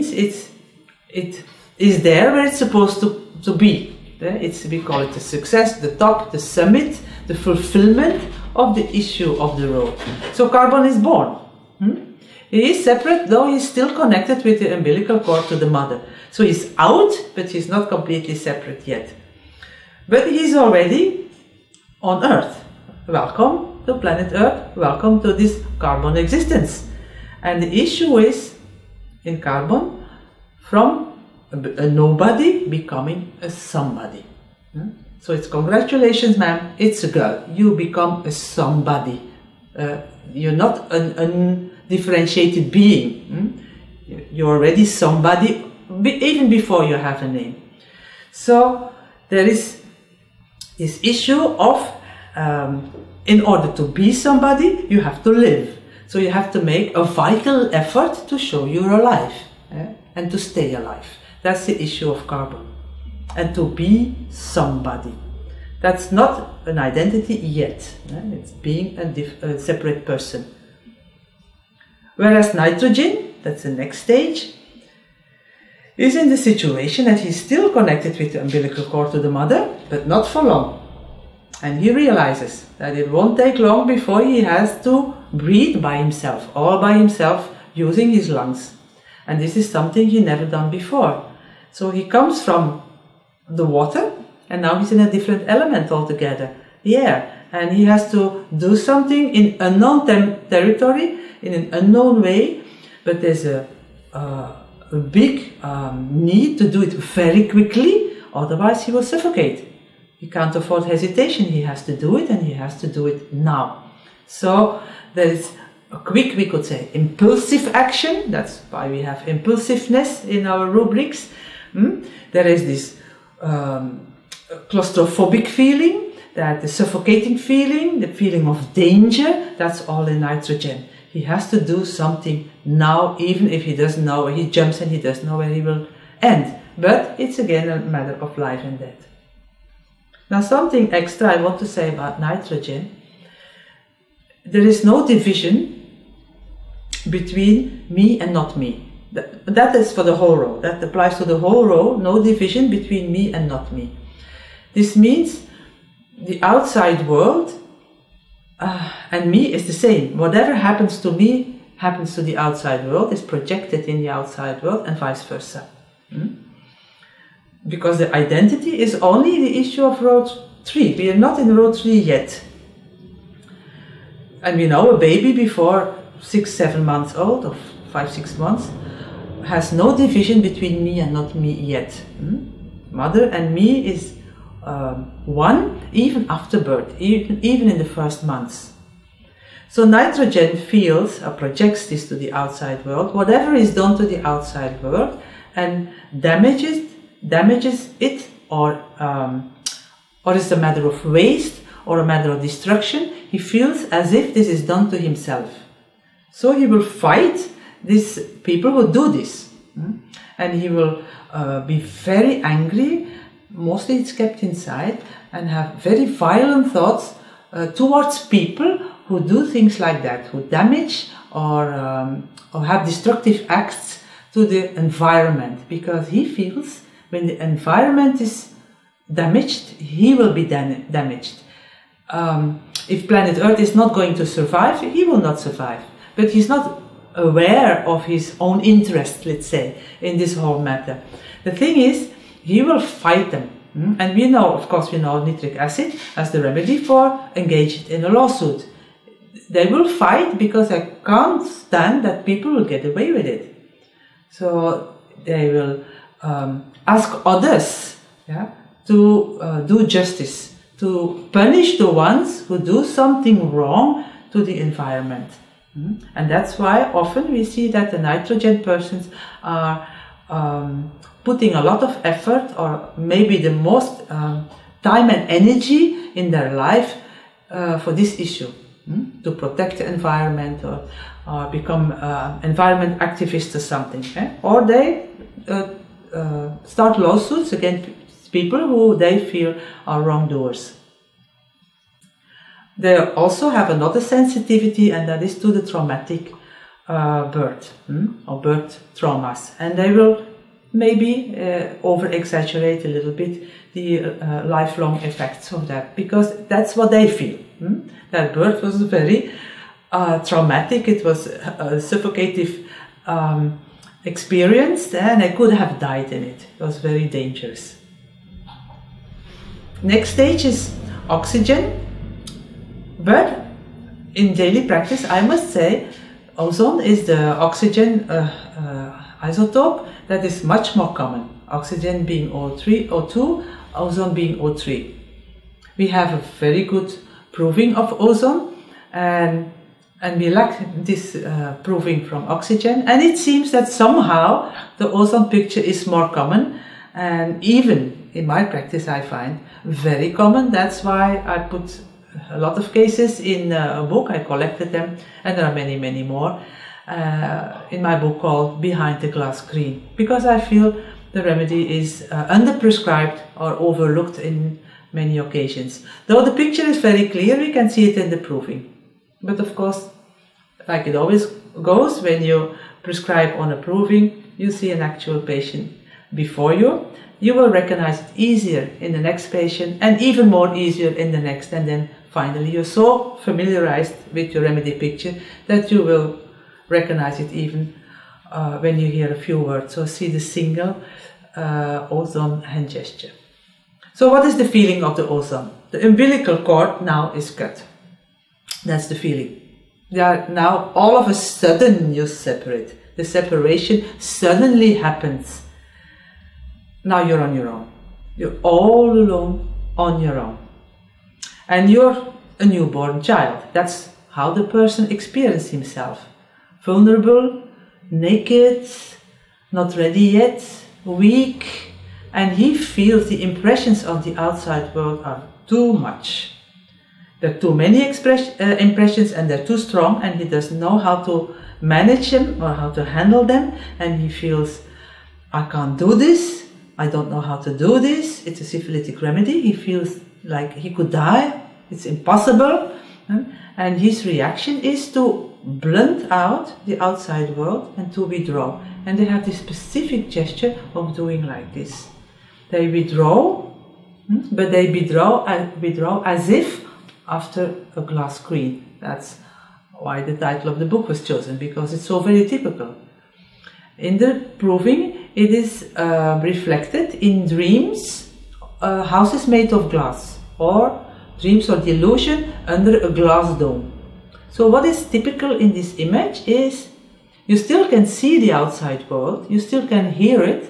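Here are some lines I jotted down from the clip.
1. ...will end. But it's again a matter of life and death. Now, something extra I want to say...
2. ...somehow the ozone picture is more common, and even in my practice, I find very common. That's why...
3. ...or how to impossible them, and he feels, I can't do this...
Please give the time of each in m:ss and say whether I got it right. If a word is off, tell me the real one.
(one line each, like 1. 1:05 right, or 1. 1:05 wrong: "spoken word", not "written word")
1. 2:15 right
2. 5:43 right
3. 7:12 wrong: "handle", not "impossible".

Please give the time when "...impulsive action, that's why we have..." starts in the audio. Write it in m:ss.
1:56.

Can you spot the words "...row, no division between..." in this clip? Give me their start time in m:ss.
2:31.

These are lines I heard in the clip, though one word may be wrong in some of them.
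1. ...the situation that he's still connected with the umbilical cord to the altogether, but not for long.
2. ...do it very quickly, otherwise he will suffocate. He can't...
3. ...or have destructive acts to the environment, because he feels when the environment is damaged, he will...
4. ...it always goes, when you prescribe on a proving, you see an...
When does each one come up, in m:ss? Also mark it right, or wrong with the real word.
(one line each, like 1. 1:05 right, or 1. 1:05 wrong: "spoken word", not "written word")
1. 1:16 wrong: "mother", not "altogether"
2. 1:46 right
3. 3:42 right
4. 6:10 right.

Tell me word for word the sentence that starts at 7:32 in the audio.
They withdraw, hmm, but they withdraw and uh, withdraw as if after a glass screen.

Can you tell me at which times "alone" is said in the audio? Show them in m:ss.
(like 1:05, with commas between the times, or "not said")
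6:48.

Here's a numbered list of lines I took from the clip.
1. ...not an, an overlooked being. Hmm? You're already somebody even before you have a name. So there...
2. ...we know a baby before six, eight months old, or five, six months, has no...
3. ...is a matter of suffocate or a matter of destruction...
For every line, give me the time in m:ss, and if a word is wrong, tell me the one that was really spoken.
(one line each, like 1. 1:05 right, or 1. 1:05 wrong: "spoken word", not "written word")
1. 0:40 wrong: "differentiated", not "overlooked"
2. 2:54 wrong: "seven", not "eight"
3. 3:20 wrong: "waste", not "suffocate".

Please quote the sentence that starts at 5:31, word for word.
Oxygen being O3, O2, ozone being O3.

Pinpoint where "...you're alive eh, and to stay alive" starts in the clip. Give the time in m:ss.
0:58.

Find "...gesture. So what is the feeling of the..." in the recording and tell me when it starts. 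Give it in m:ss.
6:32.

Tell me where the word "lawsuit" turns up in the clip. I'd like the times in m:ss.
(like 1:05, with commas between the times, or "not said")
4:08, 4:46.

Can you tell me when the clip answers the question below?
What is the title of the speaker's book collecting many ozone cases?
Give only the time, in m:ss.
5:58.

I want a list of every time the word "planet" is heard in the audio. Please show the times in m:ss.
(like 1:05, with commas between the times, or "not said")
0:23, 3:53.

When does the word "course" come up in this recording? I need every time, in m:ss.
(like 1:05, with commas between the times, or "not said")
4:04, 6:09.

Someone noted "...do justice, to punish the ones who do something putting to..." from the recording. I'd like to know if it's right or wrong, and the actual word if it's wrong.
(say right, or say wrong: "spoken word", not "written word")
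wrong: "wrong", not "putting".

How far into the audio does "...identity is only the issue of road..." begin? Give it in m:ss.
2:48.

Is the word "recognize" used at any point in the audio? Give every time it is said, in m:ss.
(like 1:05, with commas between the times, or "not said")
6:17, 6:26.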